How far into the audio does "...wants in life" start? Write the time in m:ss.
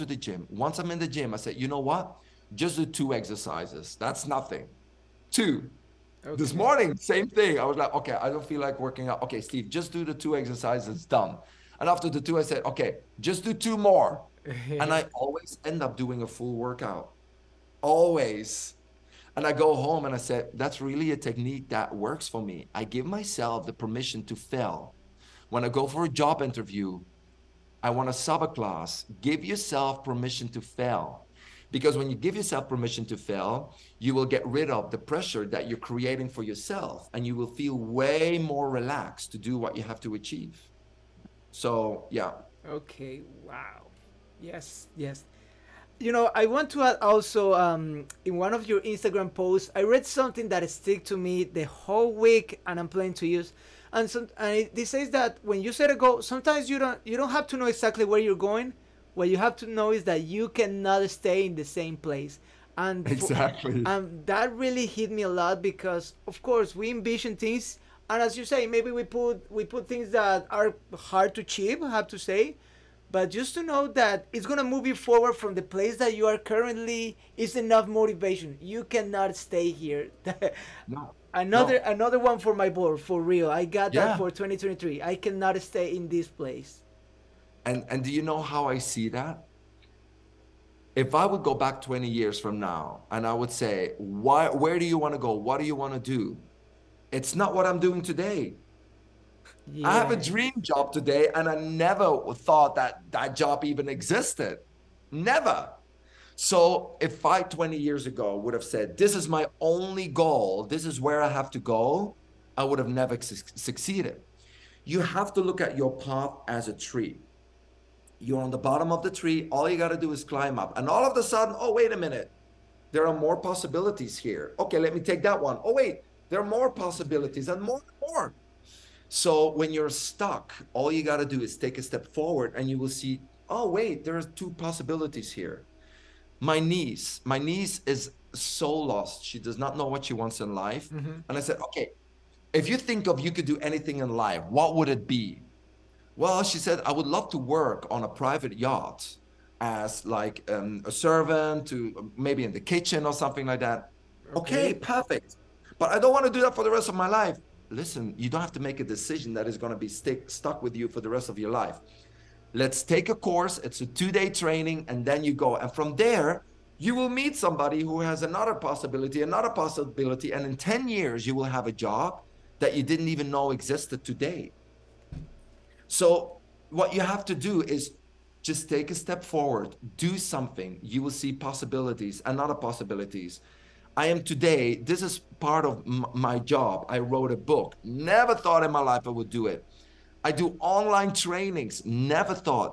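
2:20.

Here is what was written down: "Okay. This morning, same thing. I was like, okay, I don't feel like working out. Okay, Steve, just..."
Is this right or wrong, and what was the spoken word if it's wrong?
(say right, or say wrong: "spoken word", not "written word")
right.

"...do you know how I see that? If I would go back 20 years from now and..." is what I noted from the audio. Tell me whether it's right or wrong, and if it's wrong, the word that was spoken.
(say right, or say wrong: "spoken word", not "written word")
right.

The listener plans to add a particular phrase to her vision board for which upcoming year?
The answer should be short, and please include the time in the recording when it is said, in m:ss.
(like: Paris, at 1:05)
2023, at 1:24.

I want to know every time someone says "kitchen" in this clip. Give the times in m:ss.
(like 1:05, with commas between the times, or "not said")
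2:32.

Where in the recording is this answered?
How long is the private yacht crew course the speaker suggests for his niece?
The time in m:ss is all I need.
2:43.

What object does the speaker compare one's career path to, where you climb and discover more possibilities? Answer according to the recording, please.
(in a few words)
a tree.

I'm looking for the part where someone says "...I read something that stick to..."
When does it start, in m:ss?
0:49.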